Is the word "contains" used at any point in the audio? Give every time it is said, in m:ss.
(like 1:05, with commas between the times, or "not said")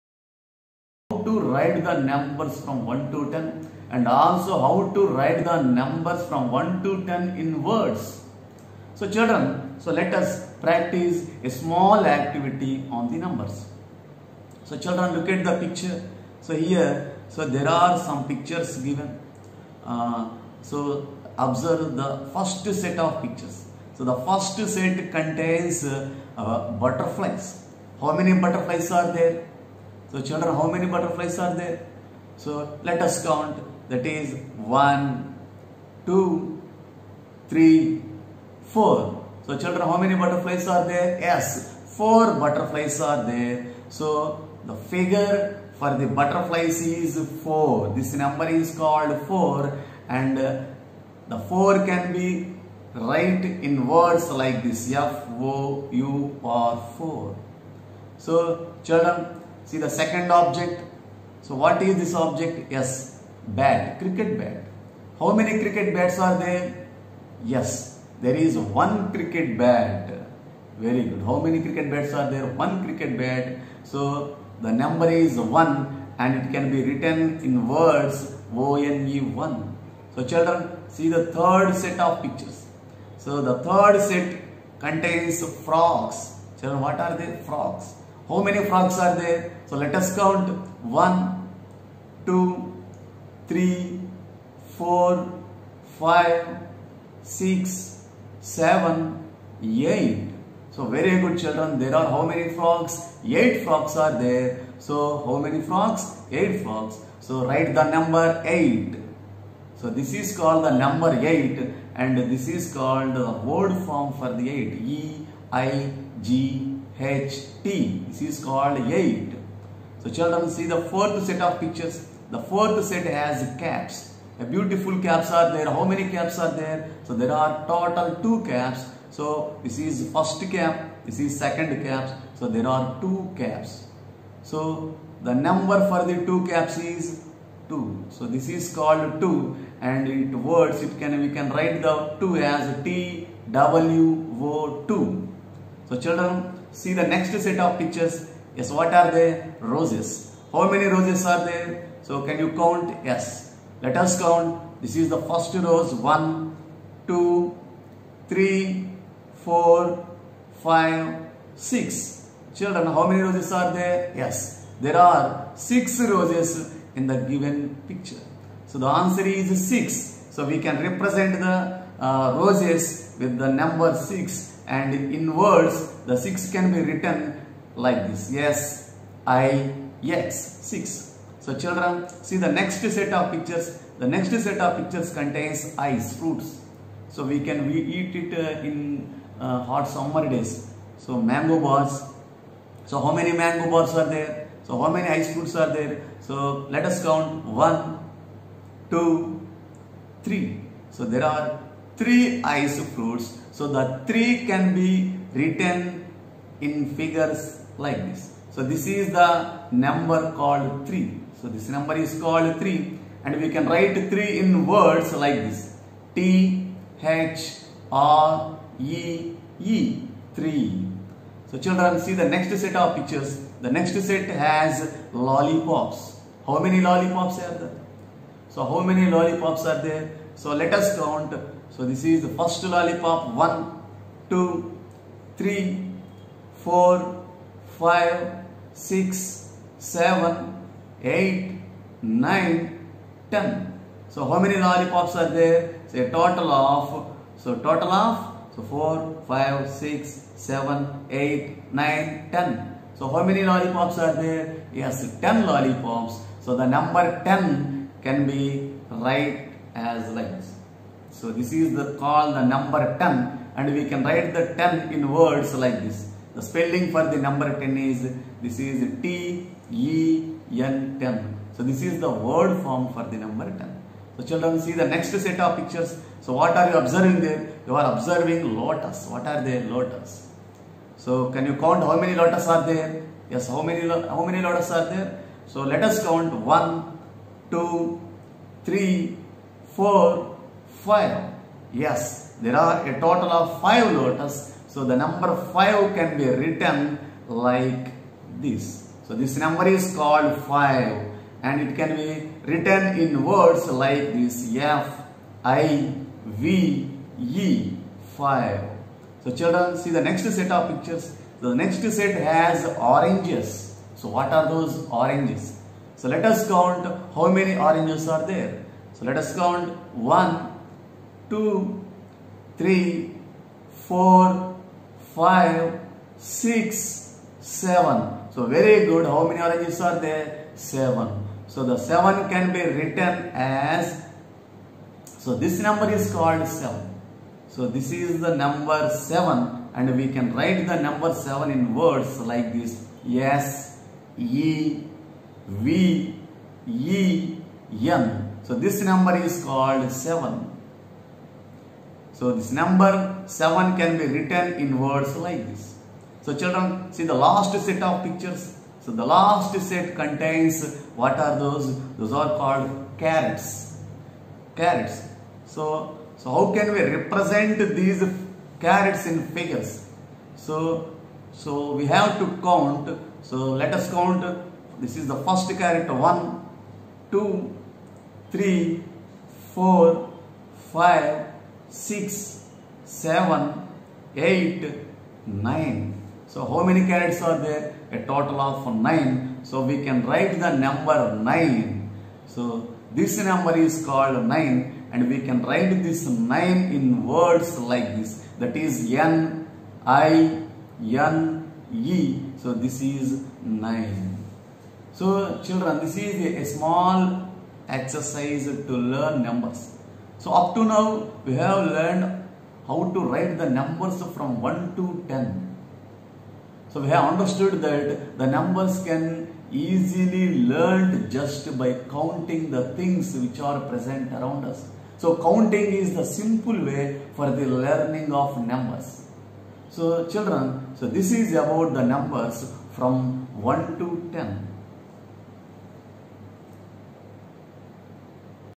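0:25, 1:24, 3:05, 5:59.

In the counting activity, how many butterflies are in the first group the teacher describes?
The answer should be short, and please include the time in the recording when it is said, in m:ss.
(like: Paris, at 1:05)
4, at 0:41.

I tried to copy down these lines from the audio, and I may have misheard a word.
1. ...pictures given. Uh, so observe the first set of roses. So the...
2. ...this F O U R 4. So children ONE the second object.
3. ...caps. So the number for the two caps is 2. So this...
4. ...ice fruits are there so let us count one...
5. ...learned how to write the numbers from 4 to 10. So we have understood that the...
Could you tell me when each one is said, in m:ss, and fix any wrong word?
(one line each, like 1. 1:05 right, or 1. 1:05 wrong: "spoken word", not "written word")
1. 0:18 wrong: "pictures", not "roses"
2. 0:54 wrong: "See", not "ONE"
3. 2:13 right
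4. 3:15 right
5. 6:51 wrong: "1", not "4".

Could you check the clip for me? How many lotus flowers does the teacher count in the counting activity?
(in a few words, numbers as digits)
5.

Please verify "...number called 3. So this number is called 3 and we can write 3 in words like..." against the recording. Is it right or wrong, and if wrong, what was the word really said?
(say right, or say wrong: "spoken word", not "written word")
right.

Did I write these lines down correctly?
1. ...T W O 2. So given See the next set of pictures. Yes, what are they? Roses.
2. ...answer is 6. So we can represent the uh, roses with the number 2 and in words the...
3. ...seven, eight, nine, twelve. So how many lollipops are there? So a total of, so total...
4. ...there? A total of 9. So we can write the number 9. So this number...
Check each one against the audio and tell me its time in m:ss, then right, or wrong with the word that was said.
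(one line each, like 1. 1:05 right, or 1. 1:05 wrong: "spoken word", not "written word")
1. 2:22 wrong: "children", not "given"
2. 2:48 wrong: "6", not "2"
3. 3:59 wrong: "ten", not "twelve"
4. 6:27 right.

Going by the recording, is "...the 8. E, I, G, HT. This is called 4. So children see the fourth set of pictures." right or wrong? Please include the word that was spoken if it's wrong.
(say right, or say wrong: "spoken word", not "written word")
wrong: "8", not "4".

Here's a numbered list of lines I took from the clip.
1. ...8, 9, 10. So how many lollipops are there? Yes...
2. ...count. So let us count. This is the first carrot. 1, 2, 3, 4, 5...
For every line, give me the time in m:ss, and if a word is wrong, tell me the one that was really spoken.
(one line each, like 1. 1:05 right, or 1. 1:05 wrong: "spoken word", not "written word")
1. 4:11 right
2. 6:12 right.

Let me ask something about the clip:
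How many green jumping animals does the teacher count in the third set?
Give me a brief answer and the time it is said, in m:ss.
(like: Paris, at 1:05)
8, at 1:43.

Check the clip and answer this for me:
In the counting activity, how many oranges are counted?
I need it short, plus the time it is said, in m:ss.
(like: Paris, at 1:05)
7, at 5:29.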